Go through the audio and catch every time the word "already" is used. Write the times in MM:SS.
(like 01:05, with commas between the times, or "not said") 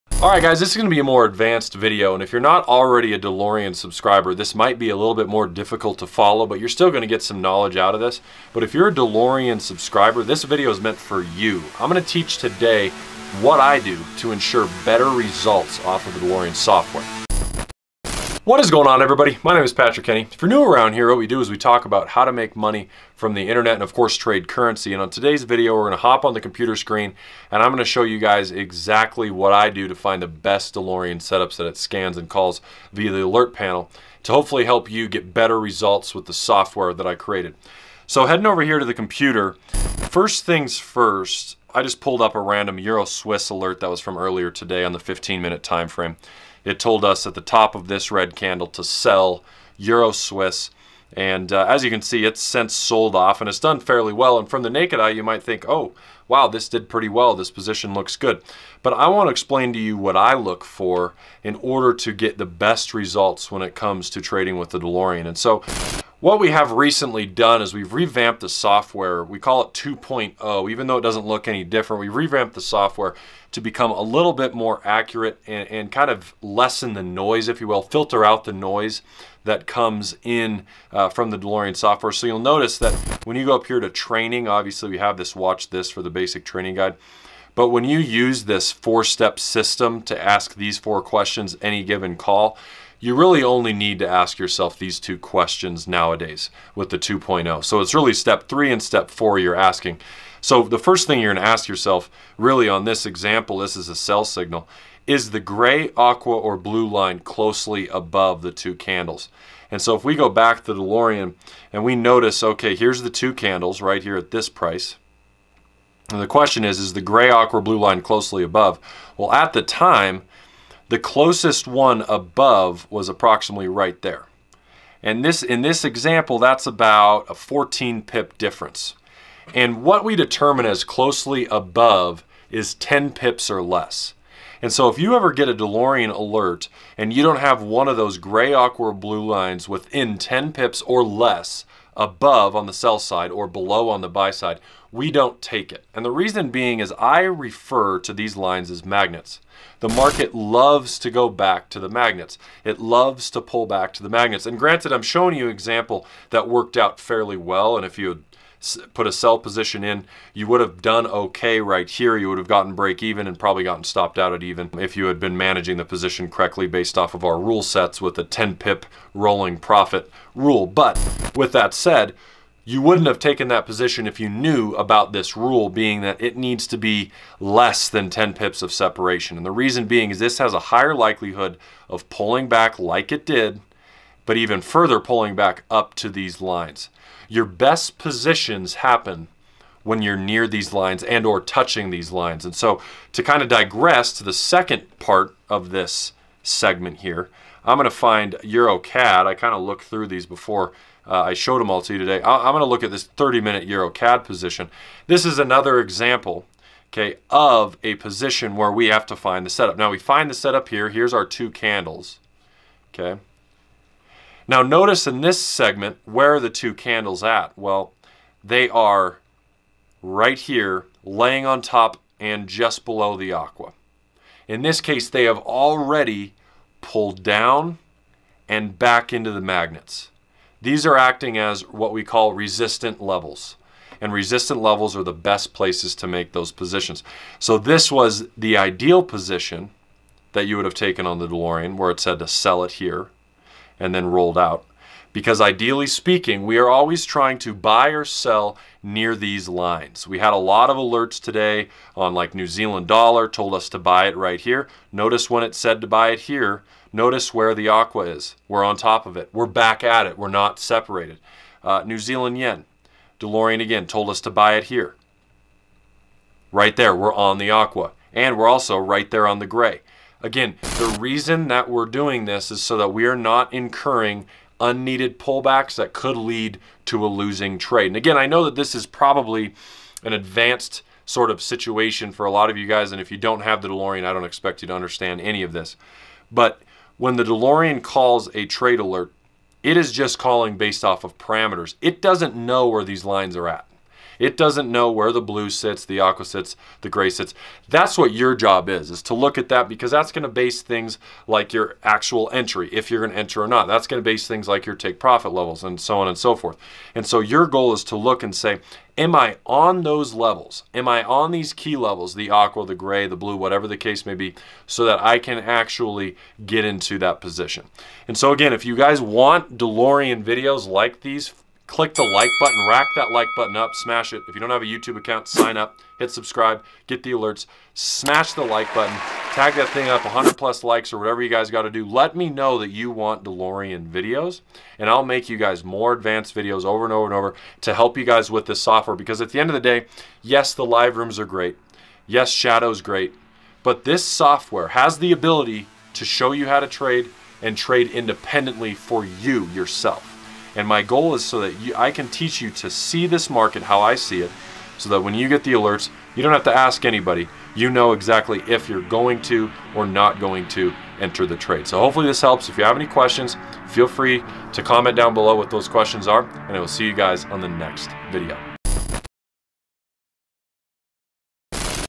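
00:02, 03:45.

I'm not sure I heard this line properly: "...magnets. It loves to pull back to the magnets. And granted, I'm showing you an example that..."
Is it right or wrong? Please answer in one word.
right.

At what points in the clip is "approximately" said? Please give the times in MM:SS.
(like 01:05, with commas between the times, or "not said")
02:03.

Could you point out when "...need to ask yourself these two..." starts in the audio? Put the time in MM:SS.
01:33.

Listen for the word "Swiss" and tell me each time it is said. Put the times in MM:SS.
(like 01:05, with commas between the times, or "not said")
00:43, 00:50.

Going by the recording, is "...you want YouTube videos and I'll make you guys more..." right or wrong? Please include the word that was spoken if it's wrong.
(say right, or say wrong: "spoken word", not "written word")
wrong: "DeLorean", not "YouTube".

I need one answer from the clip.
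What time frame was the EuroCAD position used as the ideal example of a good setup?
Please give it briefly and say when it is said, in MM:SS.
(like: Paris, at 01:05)
30-minute, at 03:23.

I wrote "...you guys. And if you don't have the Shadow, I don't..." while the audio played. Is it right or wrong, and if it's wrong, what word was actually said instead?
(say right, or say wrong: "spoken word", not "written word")
wrong: "DeLorean", not "Shadow".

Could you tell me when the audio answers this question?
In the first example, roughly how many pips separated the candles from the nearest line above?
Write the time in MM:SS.
02:07.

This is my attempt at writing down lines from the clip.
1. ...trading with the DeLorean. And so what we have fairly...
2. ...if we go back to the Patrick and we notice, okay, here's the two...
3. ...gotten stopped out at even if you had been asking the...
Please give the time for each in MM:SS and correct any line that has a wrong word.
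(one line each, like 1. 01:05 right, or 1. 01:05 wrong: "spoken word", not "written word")
1. 01:04 wrong: "recently", not "fairly"
2. 01:49 wrong: "DeLorean", not "Patrick"
3. 02:43 wrong: "managing", not "asking".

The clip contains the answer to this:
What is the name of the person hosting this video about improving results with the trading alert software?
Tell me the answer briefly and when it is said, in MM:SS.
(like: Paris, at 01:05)
Patrick Kenney, at 00:19.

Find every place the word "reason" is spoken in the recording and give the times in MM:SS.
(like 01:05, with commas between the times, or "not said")
02:26, 02:59, 04:30.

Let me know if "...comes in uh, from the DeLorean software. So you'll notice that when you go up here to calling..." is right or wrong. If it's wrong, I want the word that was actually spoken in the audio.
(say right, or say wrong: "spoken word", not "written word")
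wrong: "training", not "calling".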